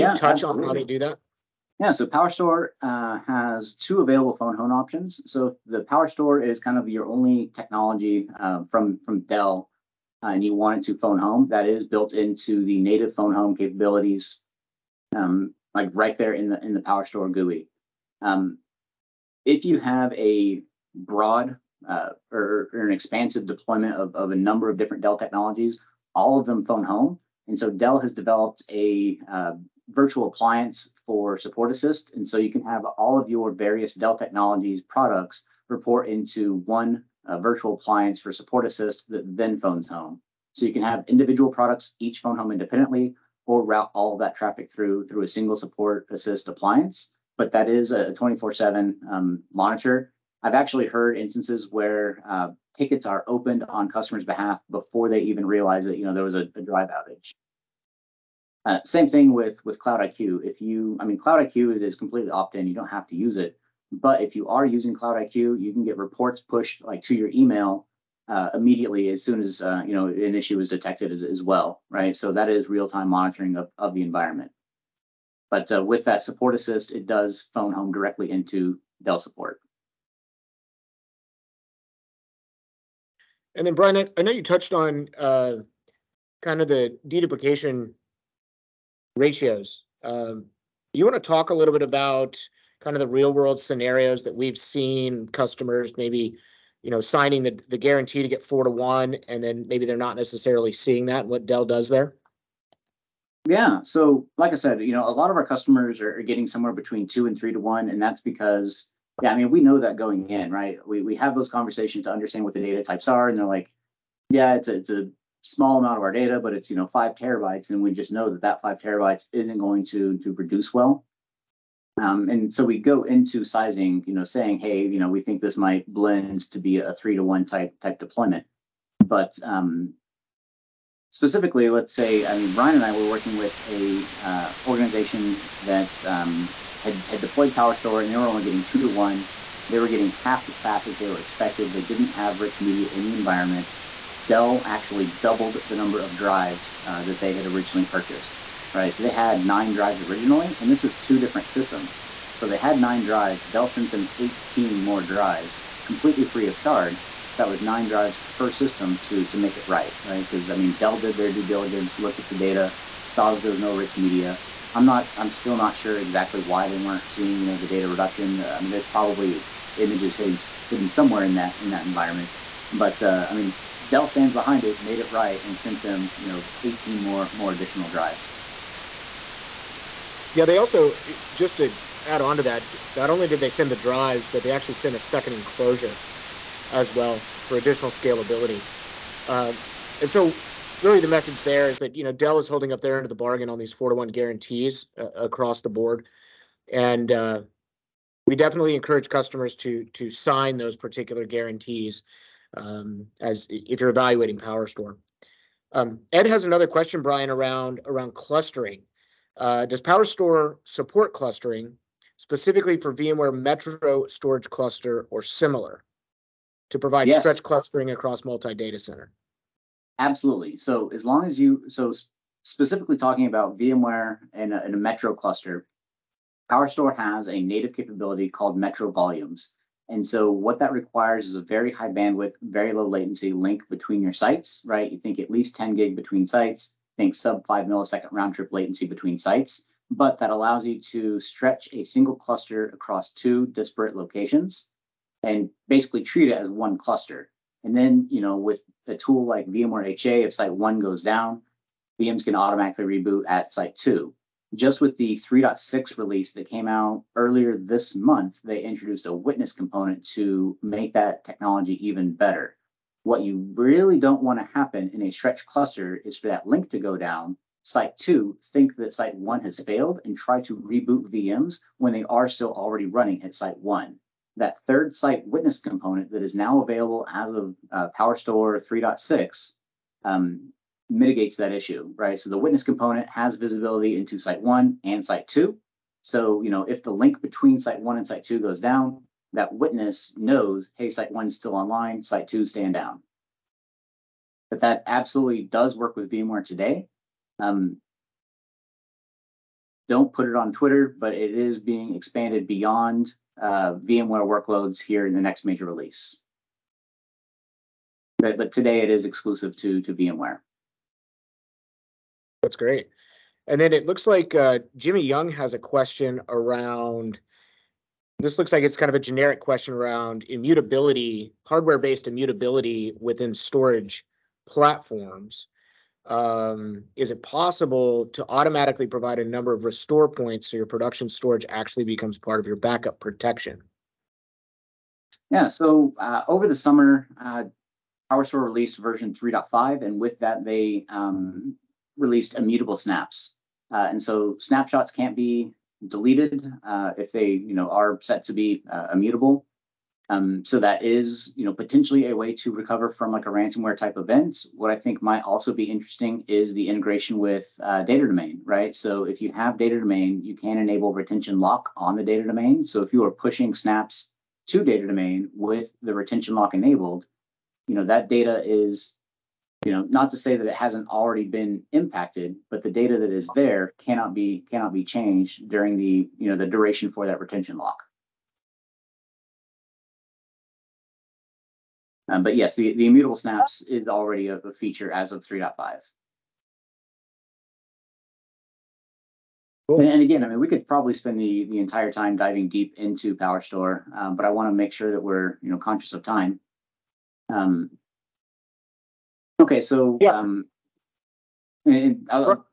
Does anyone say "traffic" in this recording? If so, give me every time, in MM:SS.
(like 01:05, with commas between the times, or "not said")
00:44.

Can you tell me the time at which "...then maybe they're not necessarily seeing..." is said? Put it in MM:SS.
01:39.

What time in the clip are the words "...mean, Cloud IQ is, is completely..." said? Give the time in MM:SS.
01:01.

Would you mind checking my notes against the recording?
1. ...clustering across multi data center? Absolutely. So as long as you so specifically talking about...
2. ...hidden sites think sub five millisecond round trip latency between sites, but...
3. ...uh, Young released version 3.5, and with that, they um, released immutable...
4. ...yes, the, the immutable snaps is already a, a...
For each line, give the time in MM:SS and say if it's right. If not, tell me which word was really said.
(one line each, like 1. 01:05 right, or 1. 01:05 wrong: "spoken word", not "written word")
1. 03:37 right
2. 03:55 wrong: "between", not "hidden"
3. 05:37 wrong: "PowerStore", not "Young"
4. 06:22 right.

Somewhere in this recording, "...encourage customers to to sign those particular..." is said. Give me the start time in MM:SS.
03:18.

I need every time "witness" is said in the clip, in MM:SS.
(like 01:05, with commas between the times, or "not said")
04:19, 04:35, 04:42, 04:49.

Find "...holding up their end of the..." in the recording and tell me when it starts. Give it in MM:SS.
03:12.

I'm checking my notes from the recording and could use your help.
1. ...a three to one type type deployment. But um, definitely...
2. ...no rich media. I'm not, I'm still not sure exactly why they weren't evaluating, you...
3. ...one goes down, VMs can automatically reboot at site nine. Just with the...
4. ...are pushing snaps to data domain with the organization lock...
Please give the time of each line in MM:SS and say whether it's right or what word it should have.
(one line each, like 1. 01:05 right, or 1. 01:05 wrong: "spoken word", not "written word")
1. 02:06 wrong: "specifically", not "definitely"
2. 02:43 wrong: "seeing", not "evaluating"
3. 04:10 wrong: "two", not "nine"
4. 06:03 wrong: "retention", not "organization".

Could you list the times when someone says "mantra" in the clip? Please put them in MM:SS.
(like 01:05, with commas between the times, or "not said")
not said.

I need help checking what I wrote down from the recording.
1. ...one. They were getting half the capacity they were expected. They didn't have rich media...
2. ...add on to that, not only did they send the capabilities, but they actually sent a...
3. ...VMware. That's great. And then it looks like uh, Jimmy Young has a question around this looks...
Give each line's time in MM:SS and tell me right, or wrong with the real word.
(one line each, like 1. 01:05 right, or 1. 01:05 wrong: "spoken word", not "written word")
1. 02:18 right
2. 03:02 wrong: "drives", not "capabilities"
3. 05:09 right.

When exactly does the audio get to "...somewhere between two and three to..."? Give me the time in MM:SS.
01:46.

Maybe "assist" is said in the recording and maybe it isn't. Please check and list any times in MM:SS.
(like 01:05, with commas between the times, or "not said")
00:31, 00:38, 00:46, 01:16.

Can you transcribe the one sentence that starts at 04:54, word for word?
But that absolutely does work with VMware today.